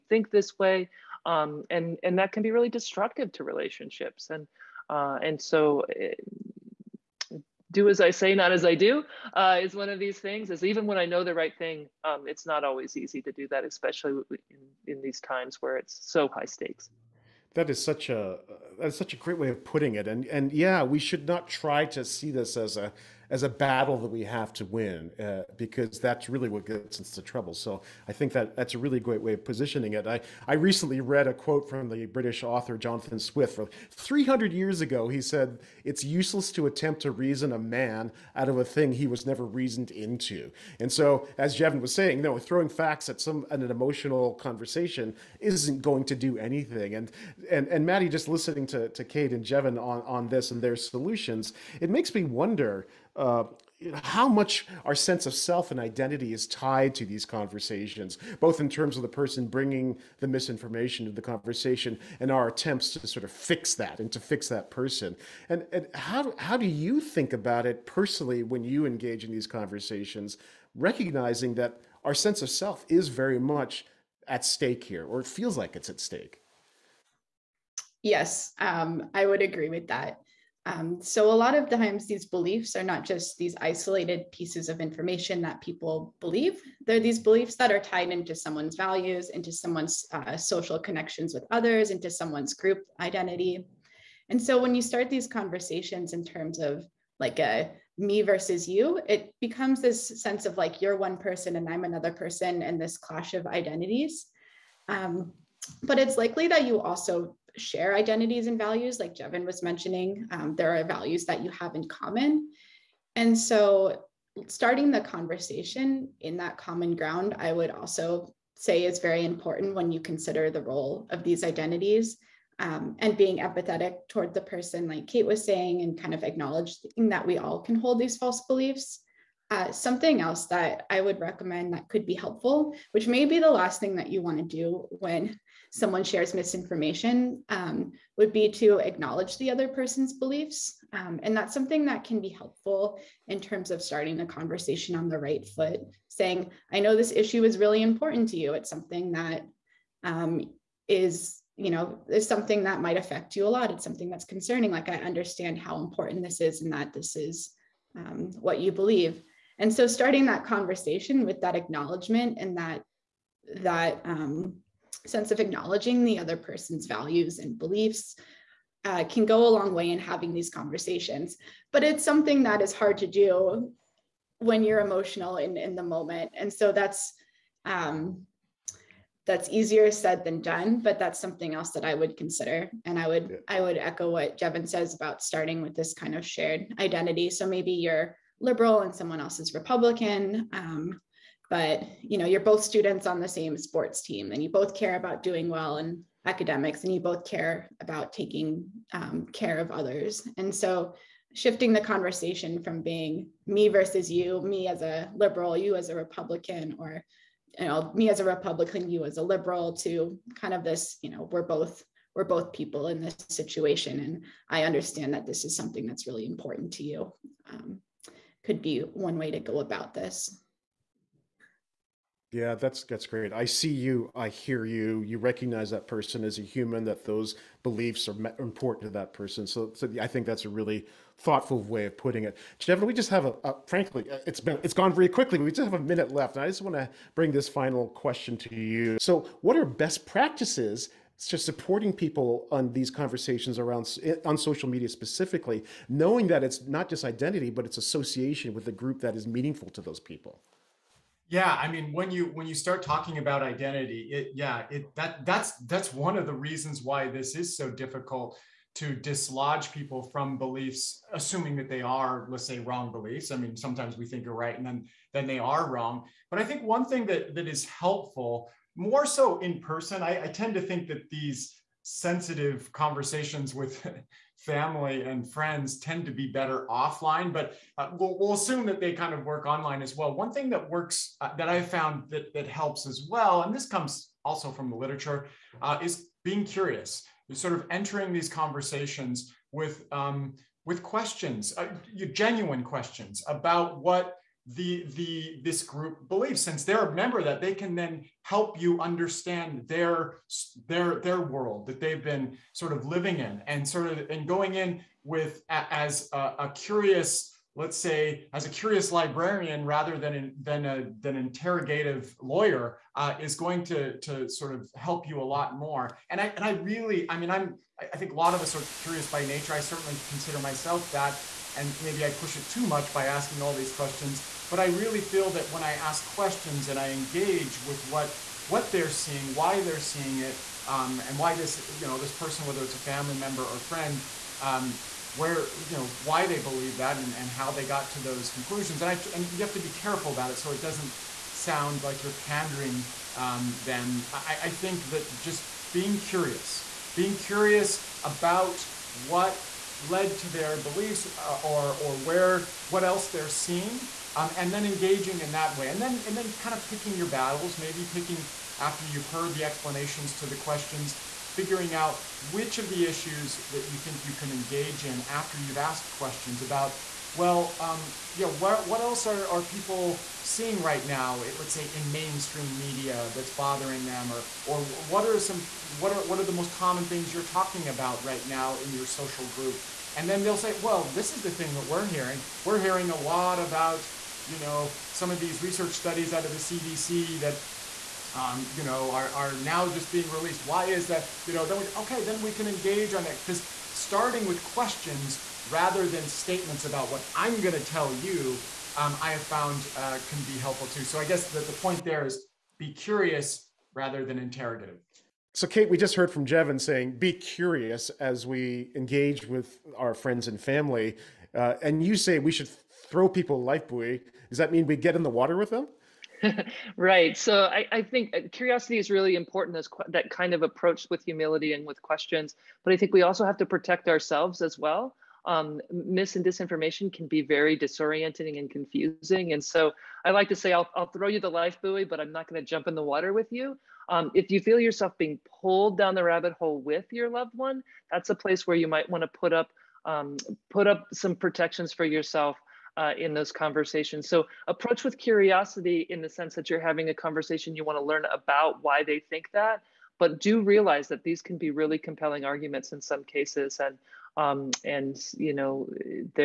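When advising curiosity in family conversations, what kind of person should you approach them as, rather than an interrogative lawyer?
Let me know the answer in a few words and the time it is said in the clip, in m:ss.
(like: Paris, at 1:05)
a curious librarian, at 5:08.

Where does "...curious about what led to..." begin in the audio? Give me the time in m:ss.
5:47.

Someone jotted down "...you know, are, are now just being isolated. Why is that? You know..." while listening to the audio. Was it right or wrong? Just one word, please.
wrong.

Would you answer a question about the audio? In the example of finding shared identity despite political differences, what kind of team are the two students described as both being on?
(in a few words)
sports team.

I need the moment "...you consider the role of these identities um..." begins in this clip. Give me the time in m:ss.
1:59.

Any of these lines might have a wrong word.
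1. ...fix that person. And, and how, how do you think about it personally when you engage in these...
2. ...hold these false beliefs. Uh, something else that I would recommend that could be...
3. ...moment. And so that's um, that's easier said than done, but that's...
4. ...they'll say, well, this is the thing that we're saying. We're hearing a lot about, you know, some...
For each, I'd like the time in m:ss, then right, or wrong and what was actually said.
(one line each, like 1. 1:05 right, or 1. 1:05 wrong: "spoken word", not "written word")
1. 1:04 right
2. 2:07 right
3. 2:55 right
4. 6:20 wrong: "hearing", not "saying".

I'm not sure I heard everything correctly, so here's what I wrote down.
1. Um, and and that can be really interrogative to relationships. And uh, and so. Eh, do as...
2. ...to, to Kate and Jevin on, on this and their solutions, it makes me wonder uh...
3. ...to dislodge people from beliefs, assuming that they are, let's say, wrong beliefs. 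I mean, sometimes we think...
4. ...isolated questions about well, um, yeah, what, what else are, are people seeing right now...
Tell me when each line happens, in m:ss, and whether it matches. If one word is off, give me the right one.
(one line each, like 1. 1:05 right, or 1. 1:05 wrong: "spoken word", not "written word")
1. 0:01 wrong: "destructive", not "interrogative"
2. 0:48 right
3. 4:18 right
4. 6:05 wrong: "asked", not "isolated".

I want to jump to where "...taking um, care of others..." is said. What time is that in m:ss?
3:18.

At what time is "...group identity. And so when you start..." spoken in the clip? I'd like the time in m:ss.
1:32.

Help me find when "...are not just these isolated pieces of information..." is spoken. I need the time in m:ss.
1:22.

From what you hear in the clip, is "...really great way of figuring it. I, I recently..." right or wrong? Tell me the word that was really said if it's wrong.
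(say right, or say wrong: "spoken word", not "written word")
wrong: "positioning", not "figuring".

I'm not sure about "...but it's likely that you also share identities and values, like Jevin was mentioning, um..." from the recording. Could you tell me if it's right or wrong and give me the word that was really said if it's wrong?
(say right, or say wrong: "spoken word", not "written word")
right.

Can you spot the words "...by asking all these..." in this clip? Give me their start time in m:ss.
5:22.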